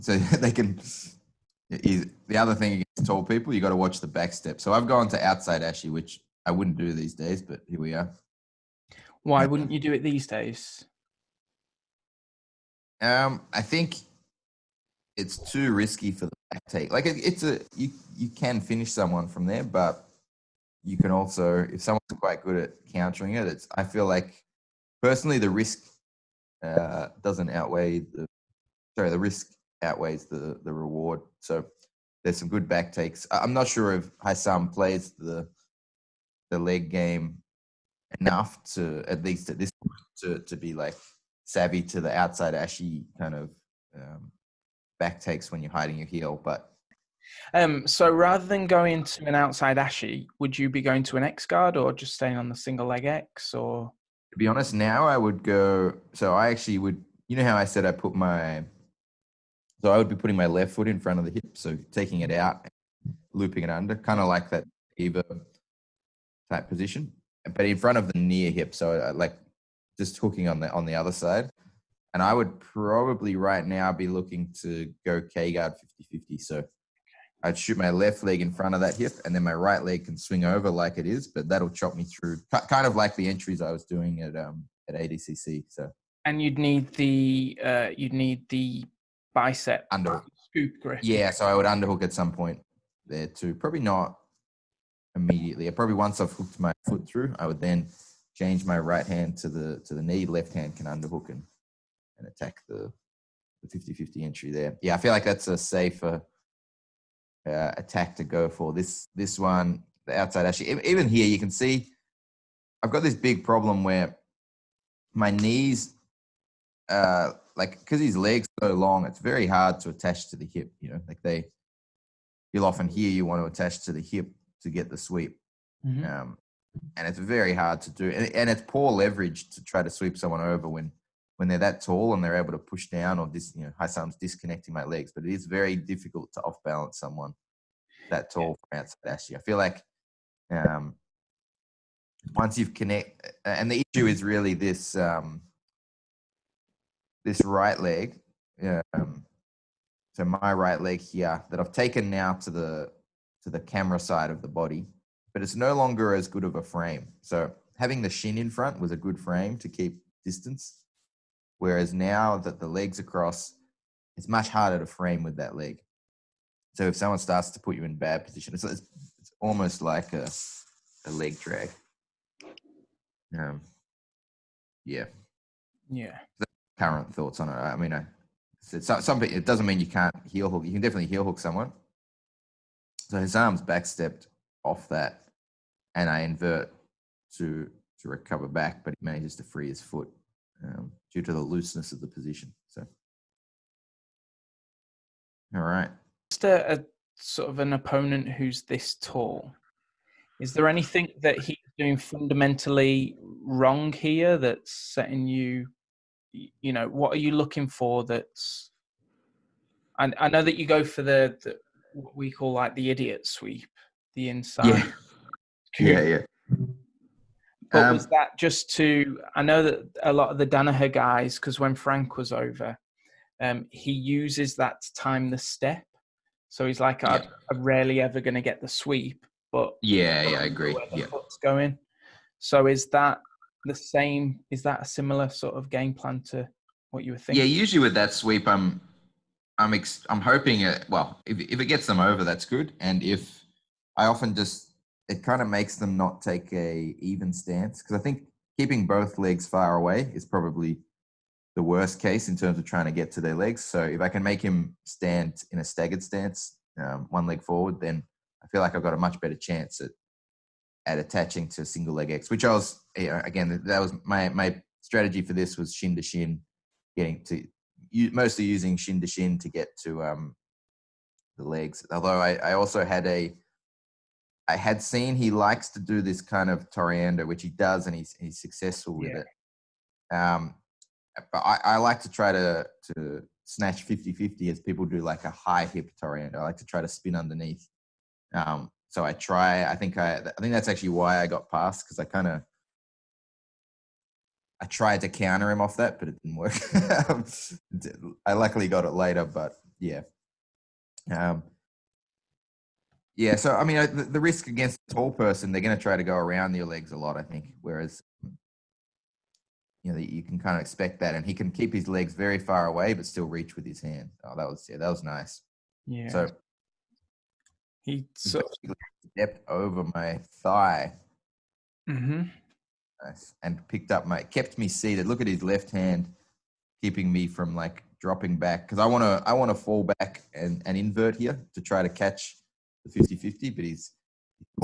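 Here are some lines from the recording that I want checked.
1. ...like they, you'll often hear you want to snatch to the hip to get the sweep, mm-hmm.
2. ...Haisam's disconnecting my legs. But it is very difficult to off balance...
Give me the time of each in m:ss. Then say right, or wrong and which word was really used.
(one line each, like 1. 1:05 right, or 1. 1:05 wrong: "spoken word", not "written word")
1. 2:01 wrong: "attach", not "snatch"
2. 2:13 right.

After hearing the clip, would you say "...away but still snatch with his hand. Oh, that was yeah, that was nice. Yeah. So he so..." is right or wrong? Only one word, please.
wrong.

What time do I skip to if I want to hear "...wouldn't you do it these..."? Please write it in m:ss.
0:09.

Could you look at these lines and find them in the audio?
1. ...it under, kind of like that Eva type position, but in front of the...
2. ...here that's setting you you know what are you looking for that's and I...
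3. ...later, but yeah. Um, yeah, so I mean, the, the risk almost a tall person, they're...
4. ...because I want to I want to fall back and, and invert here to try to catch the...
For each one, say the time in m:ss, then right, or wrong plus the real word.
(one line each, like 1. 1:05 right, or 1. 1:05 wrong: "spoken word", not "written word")
1. 1:03 right
2. 3:23 right
3. 4:58 wrong: "against", not "almost"
4. 5:28 right.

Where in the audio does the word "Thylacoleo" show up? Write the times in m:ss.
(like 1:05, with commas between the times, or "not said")
not said.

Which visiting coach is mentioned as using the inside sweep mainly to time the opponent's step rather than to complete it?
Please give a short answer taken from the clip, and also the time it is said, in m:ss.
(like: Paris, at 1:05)
Frank, at 3:41.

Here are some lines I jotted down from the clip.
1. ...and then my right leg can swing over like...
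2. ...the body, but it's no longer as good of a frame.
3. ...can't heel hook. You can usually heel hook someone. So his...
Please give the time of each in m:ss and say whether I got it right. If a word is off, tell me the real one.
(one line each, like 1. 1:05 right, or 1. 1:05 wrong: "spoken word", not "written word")
1. 1:19 right
2. 2:34 right
3. 2:59 wrong: "definitely", not "usually".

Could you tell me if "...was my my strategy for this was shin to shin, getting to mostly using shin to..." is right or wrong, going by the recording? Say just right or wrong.
right.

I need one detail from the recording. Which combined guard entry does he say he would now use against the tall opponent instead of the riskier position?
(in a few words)
K guard 50-50.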